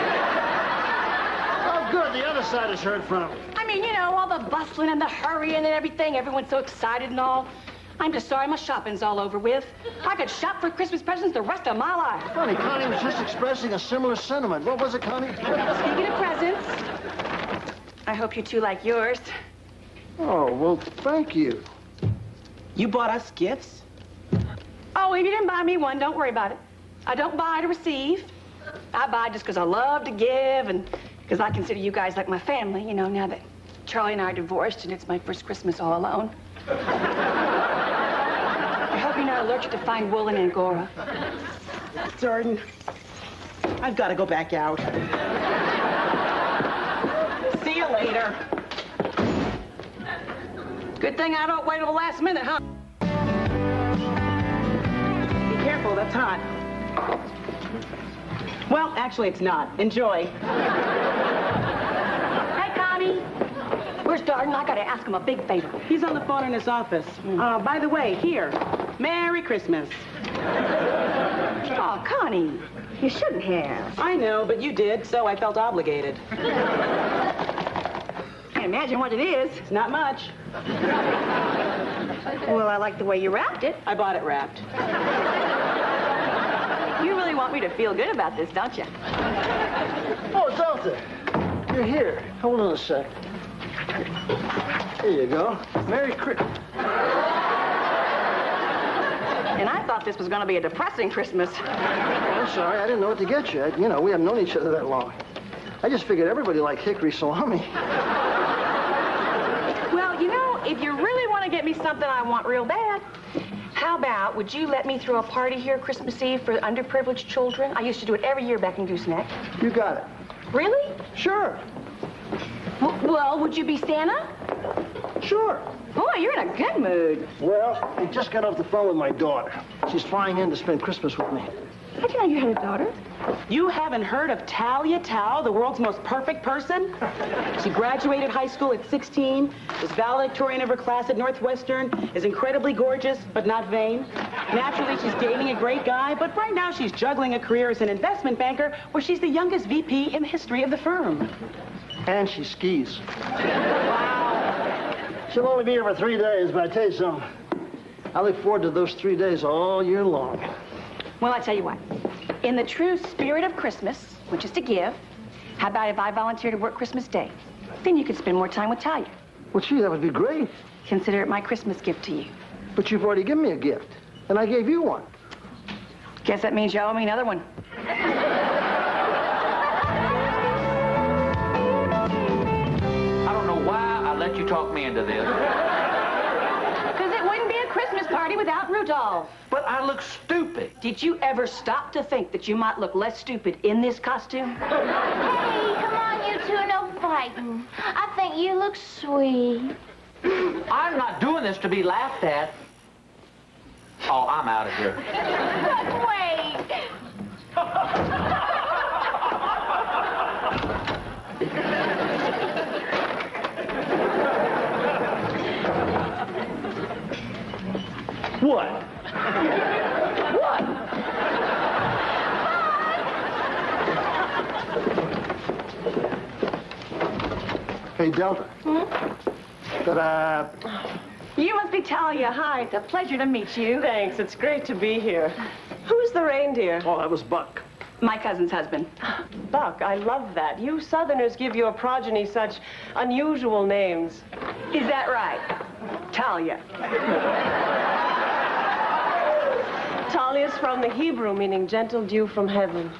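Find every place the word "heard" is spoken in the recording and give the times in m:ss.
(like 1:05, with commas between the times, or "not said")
0:02, 2:14.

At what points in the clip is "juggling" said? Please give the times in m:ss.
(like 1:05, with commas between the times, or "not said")
2:26.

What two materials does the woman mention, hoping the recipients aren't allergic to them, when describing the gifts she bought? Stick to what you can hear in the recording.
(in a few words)
Wool and angora.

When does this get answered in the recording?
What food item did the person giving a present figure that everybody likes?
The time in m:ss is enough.
1:46.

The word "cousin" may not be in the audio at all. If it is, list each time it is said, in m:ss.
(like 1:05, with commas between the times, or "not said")
3:58.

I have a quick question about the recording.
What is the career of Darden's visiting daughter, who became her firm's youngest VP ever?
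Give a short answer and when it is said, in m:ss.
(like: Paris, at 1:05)
Investment banker, at 2:27.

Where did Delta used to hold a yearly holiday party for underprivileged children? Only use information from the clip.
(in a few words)
Gooseneck.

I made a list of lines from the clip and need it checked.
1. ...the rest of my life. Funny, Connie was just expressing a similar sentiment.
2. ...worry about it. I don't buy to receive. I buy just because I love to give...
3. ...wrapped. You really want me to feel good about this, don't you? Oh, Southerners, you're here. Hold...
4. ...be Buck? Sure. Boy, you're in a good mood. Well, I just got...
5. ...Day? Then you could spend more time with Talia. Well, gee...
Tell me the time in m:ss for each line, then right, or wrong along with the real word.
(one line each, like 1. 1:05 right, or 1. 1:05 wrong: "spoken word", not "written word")
1. 0:11 right
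2. 0:26 right
3. 1:24 wrong: "Delta", not "Southerners"
4. 2:03 wrong: "Santa", not "Buck"
5. 2:47 right.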